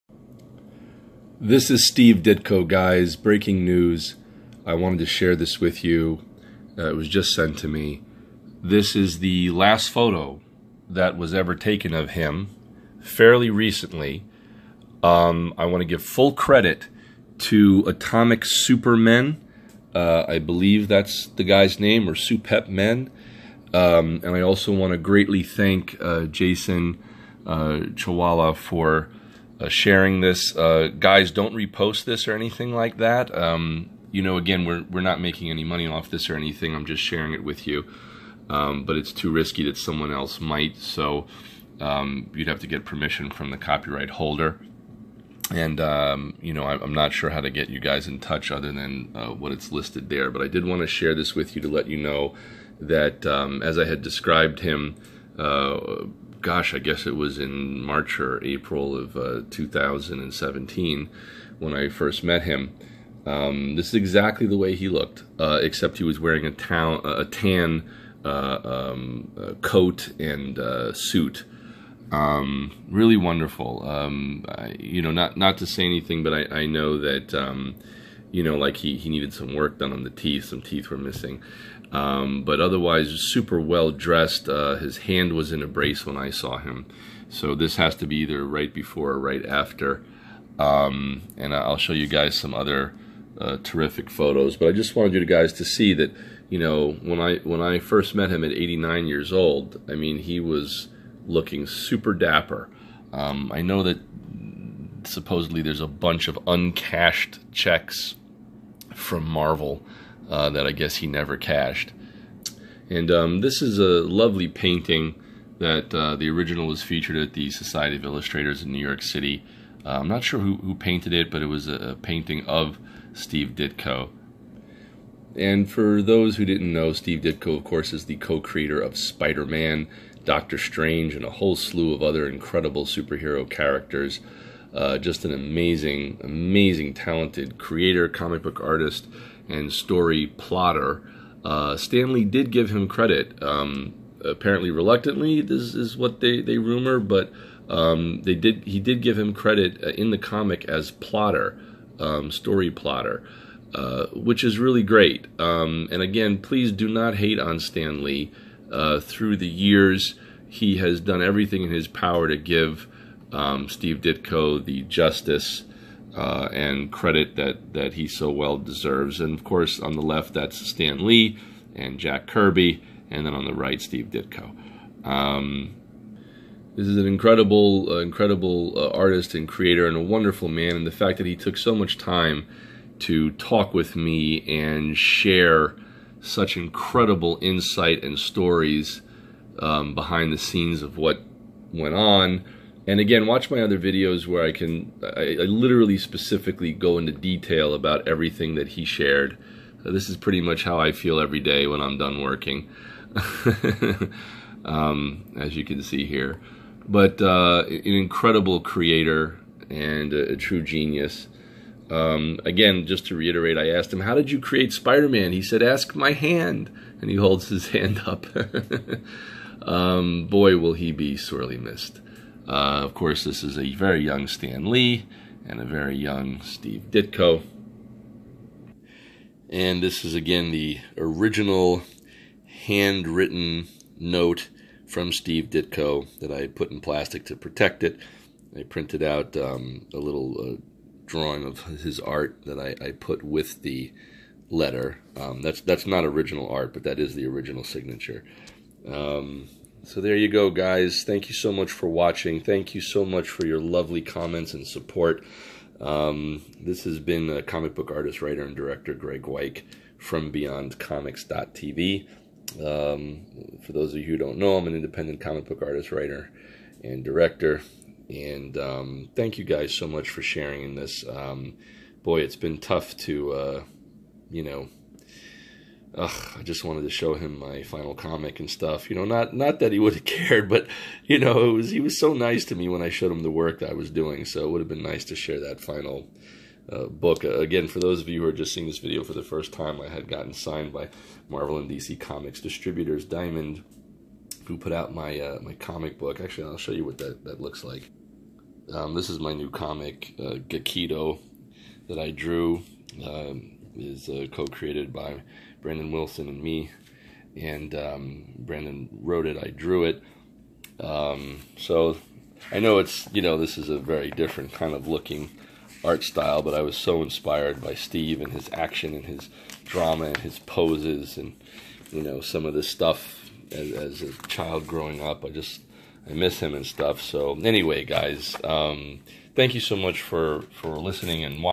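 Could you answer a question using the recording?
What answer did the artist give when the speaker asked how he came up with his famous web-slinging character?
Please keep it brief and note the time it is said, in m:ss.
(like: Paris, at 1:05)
Ask my hand, at 3:35.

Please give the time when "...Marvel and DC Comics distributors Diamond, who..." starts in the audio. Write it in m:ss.
4:51.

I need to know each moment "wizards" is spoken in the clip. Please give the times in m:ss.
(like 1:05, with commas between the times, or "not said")
not said.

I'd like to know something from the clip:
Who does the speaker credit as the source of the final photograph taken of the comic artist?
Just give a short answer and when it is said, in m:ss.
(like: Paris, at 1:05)
Atomic Supermen, at 0:17.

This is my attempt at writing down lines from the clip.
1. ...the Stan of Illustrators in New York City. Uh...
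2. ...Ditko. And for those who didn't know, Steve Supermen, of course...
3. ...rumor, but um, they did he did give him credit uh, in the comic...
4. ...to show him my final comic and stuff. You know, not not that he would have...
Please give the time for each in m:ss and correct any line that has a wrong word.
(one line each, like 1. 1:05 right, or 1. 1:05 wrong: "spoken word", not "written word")
1. 1:57 wrong: "Society", not "Stan"
2. 2:03 wrong: "Ditko", not "Supermen"
3. 2:26 right
4. 4:36 right.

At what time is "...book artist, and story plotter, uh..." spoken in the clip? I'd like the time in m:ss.
2:18.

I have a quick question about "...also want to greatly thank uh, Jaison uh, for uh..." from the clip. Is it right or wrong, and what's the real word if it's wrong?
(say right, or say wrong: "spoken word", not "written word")
right.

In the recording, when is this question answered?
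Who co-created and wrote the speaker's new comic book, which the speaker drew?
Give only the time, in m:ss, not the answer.
5:05.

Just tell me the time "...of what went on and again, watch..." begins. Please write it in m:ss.
3:10.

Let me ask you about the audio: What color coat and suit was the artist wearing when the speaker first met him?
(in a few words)
Tan.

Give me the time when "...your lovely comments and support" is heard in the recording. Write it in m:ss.
4:13.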